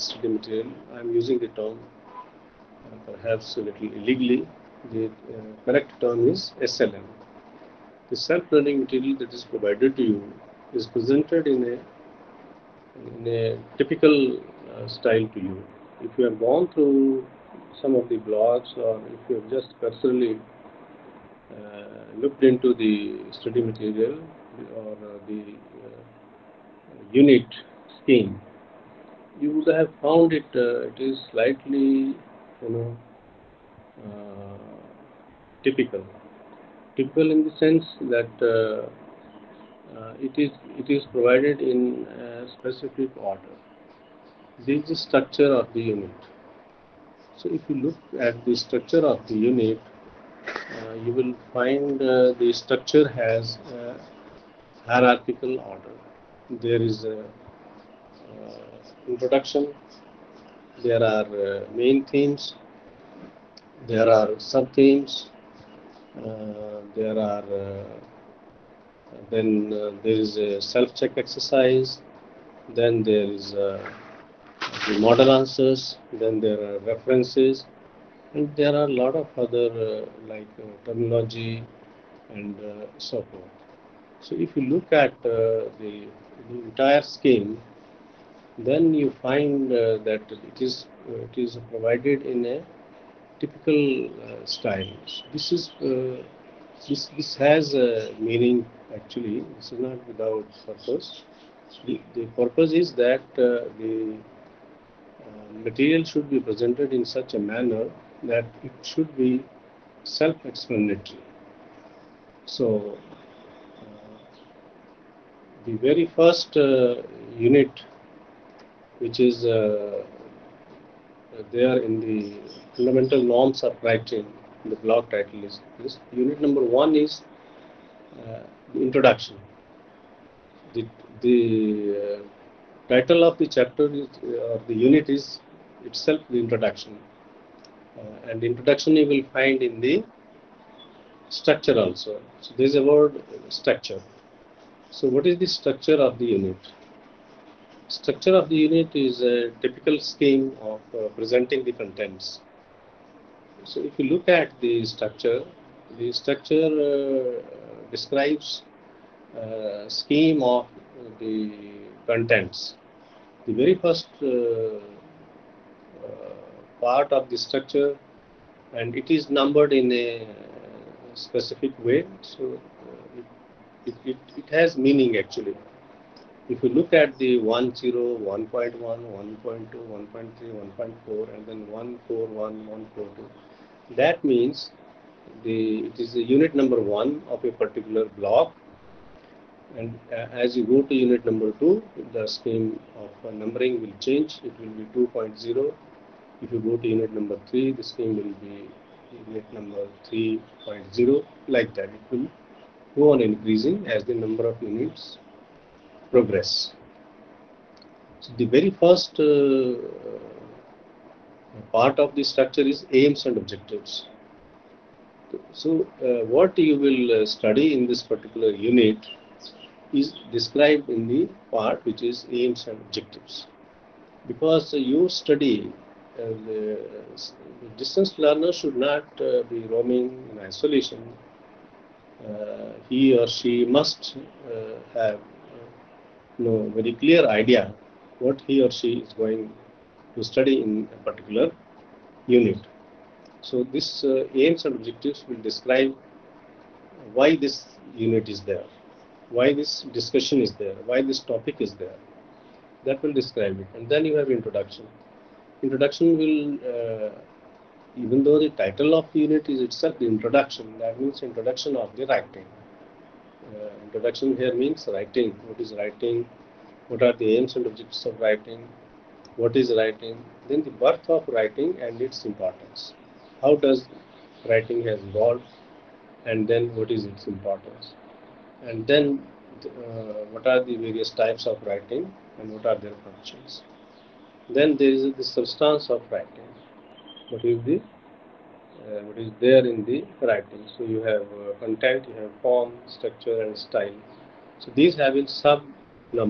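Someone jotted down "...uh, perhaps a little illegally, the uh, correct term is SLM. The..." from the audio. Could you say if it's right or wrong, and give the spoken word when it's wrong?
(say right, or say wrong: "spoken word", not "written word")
right.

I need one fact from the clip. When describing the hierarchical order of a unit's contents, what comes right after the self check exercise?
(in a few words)
model answers.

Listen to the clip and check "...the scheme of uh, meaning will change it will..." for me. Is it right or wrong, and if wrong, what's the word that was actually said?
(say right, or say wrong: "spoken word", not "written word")
wrong: "numbering", not "meaning".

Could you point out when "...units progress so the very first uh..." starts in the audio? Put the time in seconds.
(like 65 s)
204 s.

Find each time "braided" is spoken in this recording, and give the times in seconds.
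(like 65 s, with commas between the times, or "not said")
not said.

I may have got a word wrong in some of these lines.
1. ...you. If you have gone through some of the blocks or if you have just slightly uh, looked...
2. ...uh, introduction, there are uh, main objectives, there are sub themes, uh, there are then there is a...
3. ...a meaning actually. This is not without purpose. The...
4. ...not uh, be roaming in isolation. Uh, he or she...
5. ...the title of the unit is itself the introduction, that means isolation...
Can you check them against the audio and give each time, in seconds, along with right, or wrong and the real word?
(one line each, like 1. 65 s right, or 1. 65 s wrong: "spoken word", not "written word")
1. 15 s wrong: "personally", not "slightly"
2. 57 s wrong: "themes", not "objectives"
3. 97 s right
4. 228 s right
5. 258 s wrong: "introduction", not "isolation".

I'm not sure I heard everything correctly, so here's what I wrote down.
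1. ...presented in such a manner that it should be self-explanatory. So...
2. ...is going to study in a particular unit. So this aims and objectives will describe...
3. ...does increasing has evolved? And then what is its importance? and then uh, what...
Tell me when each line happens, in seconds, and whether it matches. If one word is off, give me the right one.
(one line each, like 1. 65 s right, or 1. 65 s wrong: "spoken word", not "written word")
1. 106 s right
2. 238 s right
3. 273 s wrong: "writing", not "increasing".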